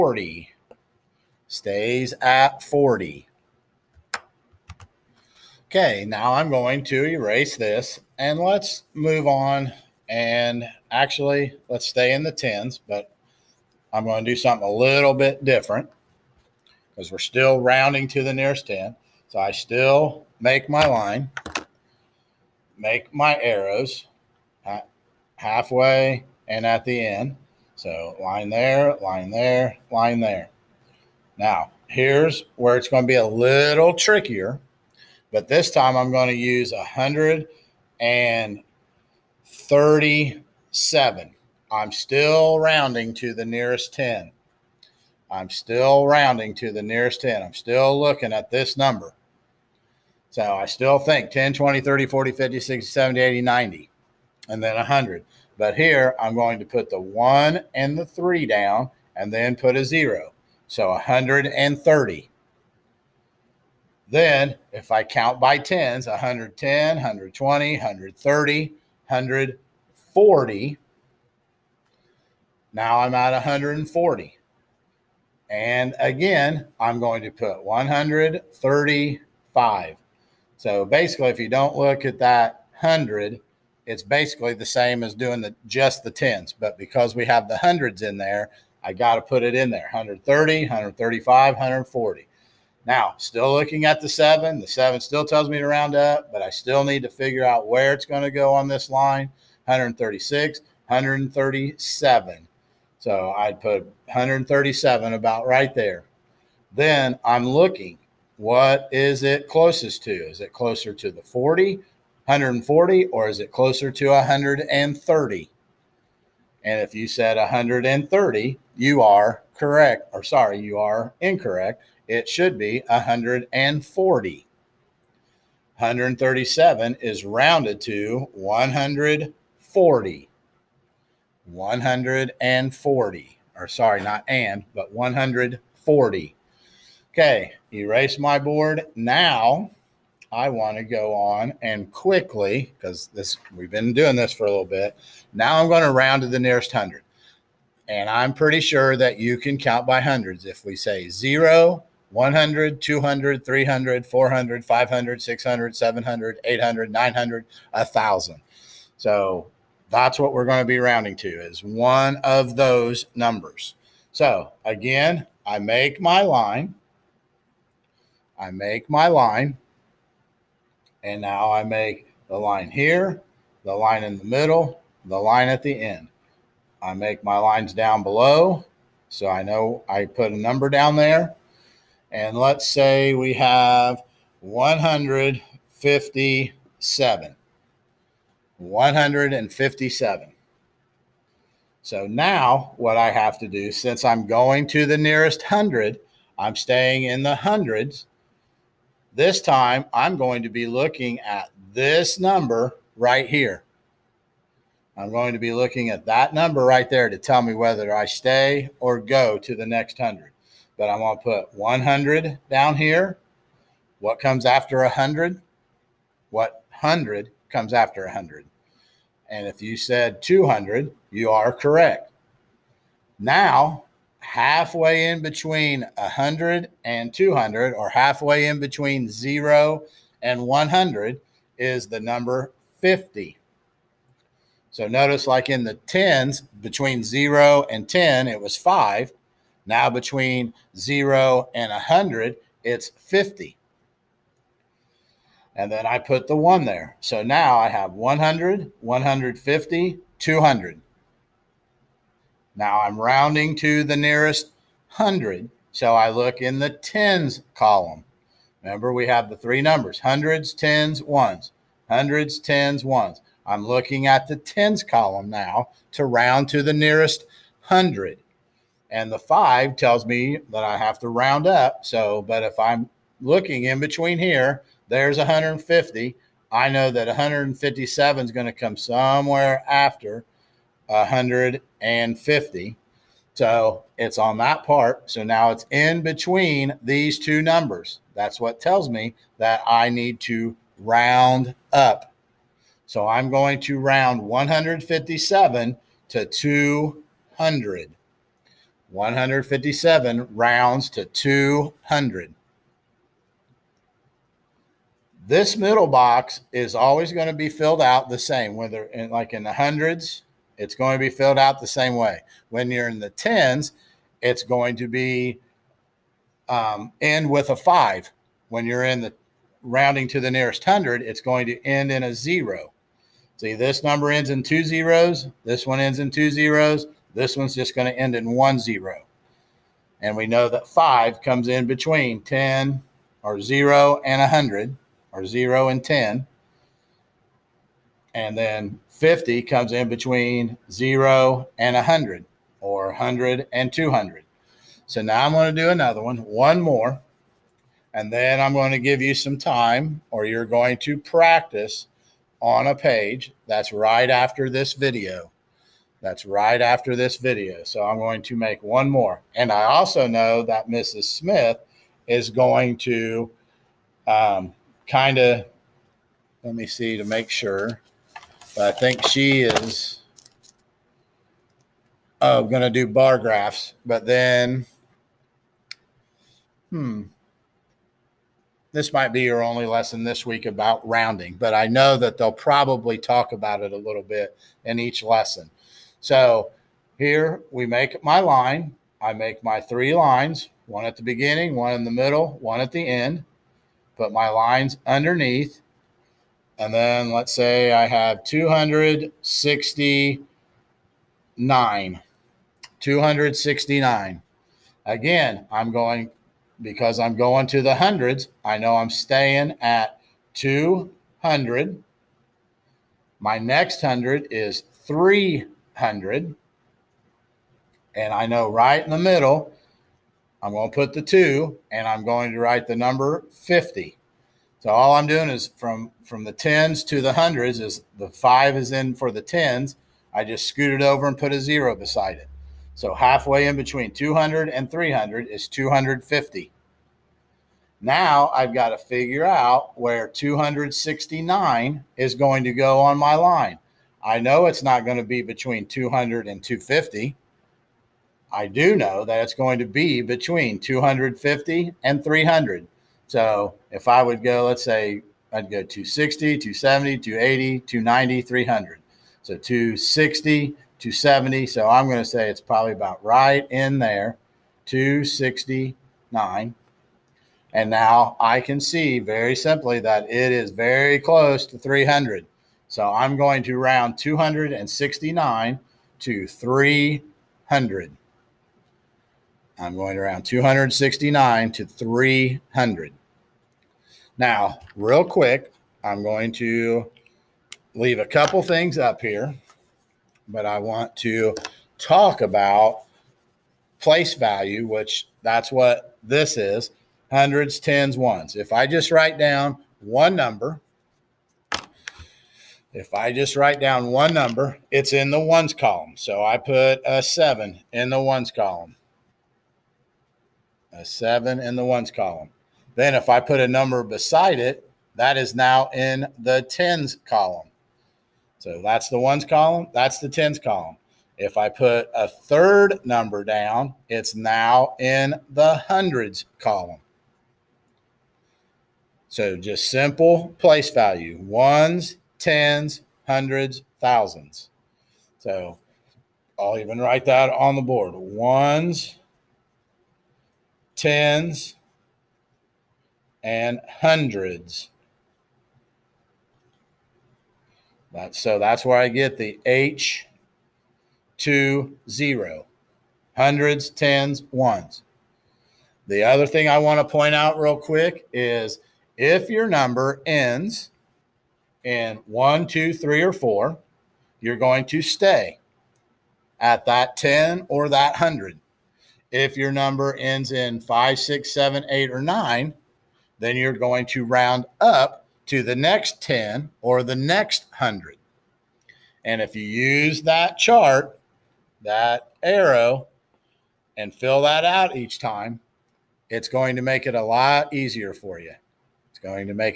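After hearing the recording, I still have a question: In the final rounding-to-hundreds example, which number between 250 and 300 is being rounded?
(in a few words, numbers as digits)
269.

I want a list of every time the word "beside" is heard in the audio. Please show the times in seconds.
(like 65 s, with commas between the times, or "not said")
431 s, 513 s.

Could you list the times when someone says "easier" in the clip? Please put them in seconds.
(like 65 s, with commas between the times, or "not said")
587 s.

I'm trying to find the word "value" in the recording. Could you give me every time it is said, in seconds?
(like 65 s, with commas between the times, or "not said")
494 s, 530 s.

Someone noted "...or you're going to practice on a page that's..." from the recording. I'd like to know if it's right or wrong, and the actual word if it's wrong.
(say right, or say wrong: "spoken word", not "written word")
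right.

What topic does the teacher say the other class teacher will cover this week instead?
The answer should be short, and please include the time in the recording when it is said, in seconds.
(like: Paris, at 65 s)
bar graphs, at 372 s.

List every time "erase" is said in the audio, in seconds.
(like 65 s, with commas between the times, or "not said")
7 s, 137 s.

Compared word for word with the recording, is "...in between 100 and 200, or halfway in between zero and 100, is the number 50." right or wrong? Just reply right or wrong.
right.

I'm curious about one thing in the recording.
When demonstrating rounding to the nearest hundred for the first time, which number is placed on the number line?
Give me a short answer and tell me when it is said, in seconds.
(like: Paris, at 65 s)
157, at 182 s.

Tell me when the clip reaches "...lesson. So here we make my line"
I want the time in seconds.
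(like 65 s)
385 s.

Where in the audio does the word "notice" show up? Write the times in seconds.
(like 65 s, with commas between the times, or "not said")
234 s.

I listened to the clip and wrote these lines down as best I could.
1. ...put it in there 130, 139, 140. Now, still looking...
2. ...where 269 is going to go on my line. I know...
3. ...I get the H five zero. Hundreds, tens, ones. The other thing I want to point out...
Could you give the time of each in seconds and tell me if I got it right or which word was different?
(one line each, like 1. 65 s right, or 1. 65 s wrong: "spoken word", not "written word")
1. 89 s wrong: "135", not "139"
2. 439 s right
3. 548 s wrong: "two", not "five".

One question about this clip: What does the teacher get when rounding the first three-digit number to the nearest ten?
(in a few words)
140.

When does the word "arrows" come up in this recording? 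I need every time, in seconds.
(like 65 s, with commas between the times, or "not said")
23 s, 582 s.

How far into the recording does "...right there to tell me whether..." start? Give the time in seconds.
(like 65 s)
206 s.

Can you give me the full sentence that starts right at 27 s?
So line there, line there, line there.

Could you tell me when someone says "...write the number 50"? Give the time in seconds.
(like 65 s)
422 s.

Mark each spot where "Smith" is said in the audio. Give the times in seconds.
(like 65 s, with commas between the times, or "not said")
361 s.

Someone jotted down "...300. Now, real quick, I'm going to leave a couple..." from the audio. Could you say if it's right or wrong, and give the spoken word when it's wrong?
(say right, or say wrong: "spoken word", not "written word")
right.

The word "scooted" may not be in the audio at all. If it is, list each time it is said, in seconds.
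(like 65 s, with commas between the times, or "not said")
430 s.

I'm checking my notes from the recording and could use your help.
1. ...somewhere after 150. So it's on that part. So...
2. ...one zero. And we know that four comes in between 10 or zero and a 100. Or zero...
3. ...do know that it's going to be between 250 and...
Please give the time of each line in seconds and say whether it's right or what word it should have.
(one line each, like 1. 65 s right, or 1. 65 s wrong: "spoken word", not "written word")
1. 278 s right
2. 328 s wrong: "five", not "four"
3. 448 s right.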